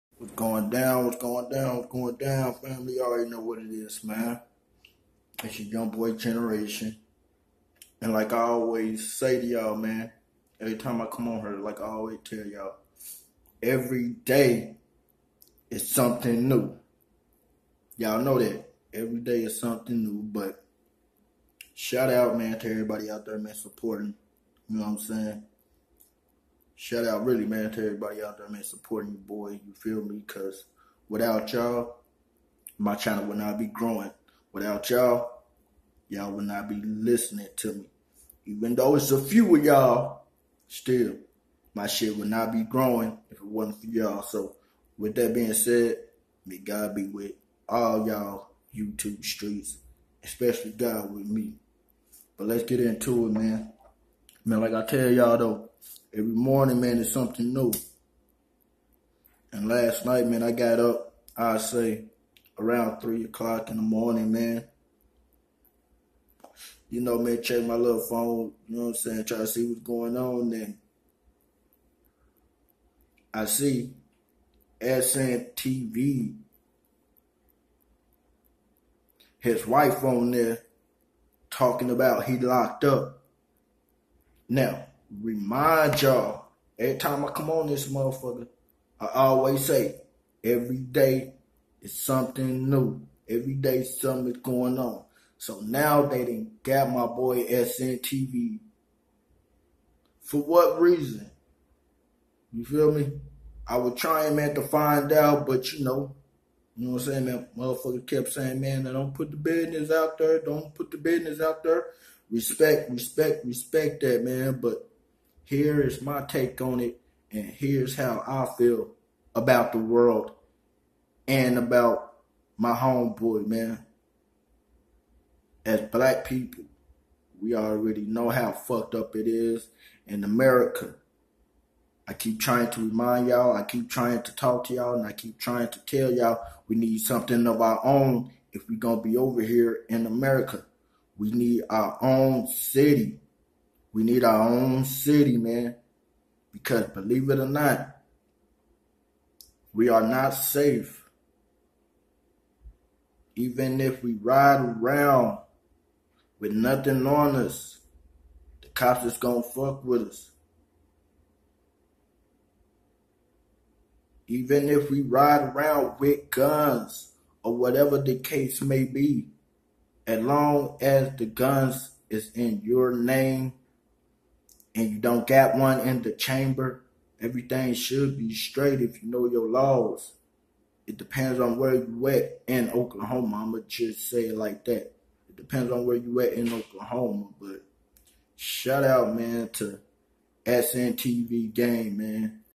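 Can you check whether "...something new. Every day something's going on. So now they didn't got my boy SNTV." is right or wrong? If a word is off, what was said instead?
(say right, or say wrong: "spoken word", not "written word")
right.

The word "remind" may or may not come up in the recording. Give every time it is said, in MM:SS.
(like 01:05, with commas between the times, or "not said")
01:25, 02:12.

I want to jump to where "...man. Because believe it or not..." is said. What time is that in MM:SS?
02:25.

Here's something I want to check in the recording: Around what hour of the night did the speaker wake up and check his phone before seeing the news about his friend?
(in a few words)
3 o'clock.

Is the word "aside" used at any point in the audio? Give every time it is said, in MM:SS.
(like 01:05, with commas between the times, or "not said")
not said.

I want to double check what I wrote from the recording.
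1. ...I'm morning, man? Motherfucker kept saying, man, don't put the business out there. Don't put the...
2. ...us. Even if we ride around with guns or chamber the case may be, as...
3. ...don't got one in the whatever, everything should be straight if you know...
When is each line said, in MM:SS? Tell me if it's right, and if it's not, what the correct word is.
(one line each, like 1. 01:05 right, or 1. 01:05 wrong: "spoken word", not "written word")
1. 01:47 wrong: "saying", not "morning"
2. 02:40 wrong: "whatever", not "chamber"
3. 02:54 wrong: "chamber", not "whatever".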